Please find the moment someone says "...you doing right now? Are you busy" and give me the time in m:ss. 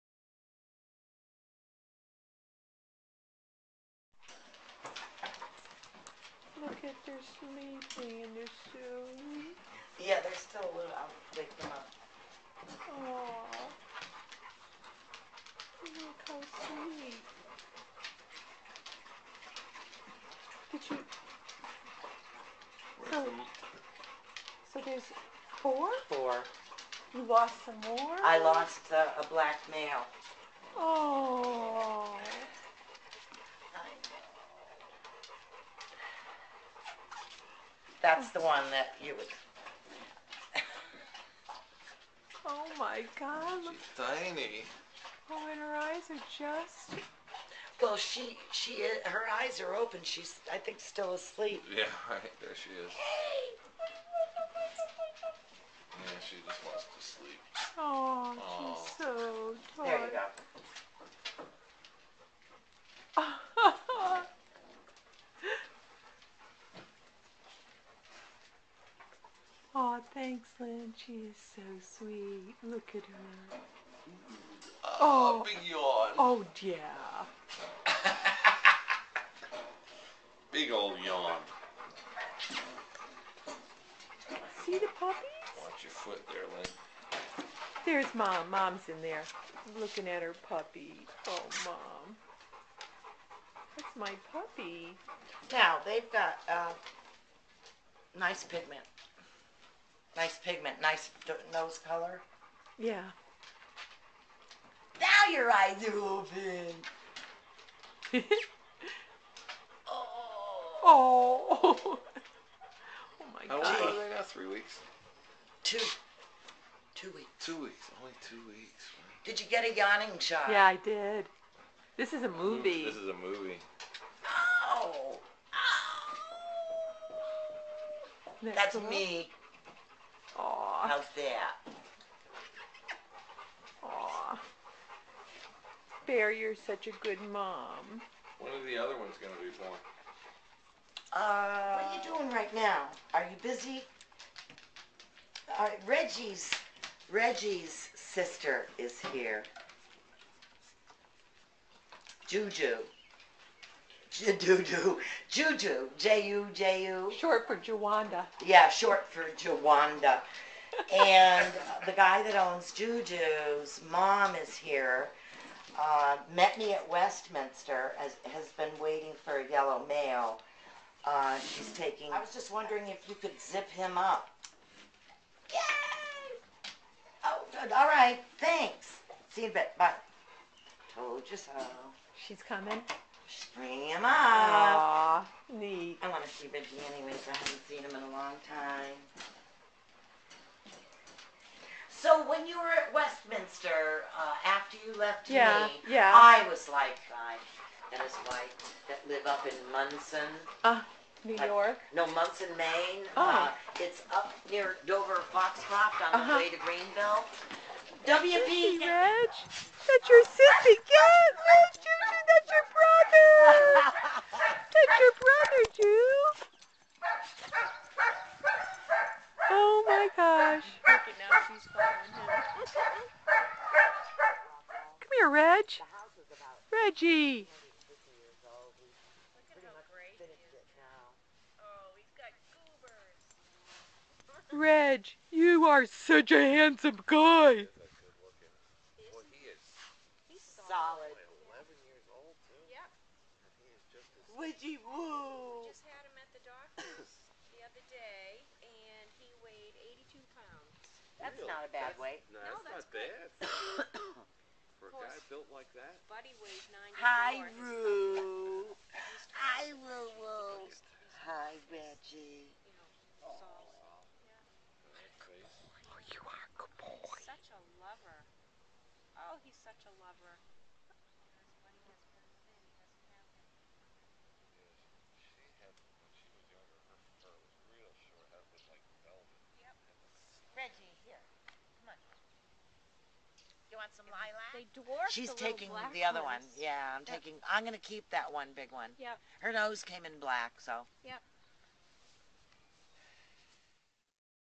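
2:21.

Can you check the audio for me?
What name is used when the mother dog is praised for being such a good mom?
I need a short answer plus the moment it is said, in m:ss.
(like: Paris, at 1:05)
Bear, at 2:16.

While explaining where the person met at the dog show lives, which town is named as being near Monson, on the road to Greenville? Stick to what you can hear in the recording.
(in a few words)
Dover Foxcroft.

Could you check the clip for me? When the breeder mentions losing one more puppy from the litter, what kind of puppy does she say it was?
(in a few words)
a black male.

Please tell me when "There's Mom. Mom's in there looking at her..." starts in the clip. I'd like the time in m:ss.
1:27.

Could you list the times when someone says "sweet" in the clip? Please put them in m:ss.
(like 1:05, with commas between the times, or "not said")
0:16, 1:11.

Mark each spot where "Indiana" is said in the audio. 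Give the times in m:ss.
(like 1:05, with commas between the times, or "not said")
not said.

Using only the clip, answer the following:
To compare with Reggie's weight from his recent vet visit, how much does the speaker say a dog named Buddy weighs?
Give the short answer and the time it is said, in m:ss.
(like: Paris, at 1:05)
94, at 4:16.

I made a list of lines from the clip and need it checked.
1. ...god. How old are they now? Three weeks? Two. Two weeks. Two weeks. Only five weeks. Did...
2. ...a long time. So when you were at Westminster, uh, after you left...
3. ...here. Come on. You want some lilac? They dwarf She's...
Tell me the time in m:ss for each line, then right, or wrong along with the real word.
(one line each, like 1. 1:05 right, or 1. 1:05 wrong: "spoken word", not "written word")
1. 1:53 wrong: "two", not "five"
2. 3:08 right
3. 4:41 right.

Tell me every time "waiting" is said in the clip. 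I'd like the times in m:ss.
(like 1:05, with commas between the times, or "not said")
2:48.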